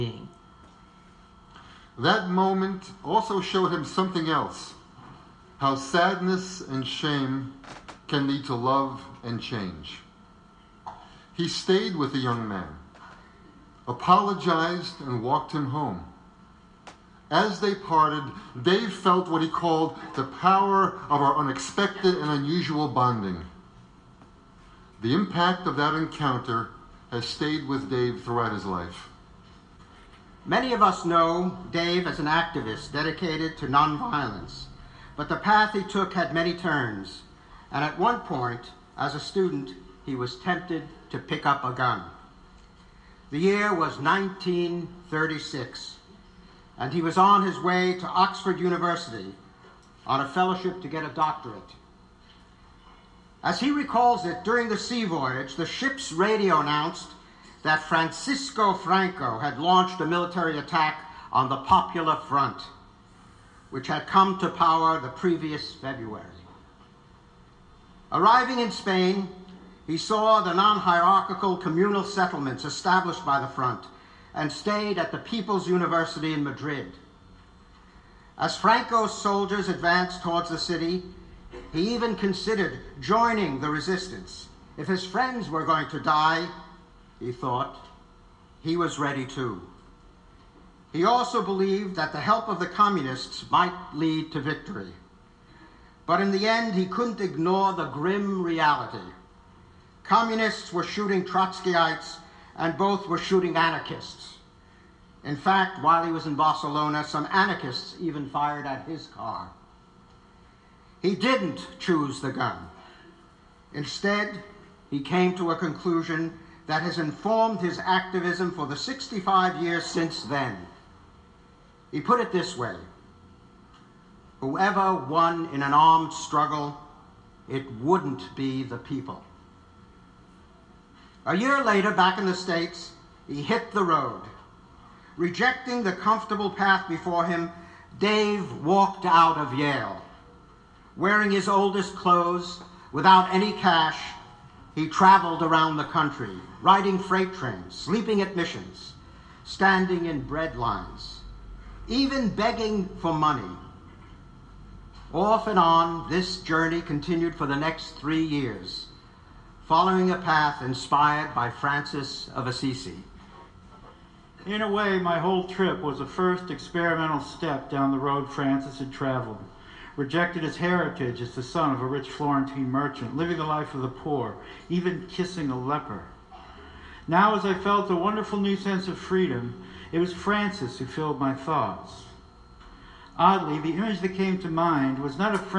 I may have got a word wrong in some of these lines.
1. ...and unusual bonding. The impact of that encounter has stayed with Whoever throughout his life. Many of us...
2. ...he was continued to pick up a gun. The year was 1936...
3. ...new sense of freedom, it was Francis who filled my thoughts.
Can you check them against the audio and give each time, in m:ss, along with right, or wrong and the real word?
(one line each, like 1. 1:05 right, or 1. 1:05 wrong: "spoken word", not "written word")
1. 0:22 wrong: "Dave", not "Whoever"
2. 0:40 wrong: "tempted", not "continued"
3. 2:58 right.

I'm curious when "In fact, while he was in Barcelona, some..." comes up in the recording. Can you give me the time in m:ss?
1:45.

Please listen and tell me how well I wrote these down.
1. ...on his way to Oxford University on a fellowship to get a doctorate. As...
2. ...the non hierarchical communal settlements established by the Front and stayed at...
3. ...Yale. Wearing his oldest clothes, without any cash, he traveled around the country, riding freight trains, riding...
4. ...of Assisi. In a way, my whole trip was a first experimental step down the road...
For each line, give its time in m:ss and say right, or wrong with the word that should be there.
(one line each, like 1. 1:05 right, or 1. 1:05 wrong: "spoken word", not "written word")
1. 0:47 right
2. 1:10 right
3. 2:19 wrong: "sleeping", not "riding"
4. 2:42 right.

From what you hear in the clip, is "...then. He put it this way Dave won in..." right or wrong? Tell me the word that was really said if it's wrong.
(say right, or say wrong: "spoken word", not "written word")
wrong: "Whoever", not "Dave".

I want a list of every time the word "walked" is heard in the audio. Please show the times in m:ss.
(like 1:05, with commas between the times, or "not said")
0:15, 2:18.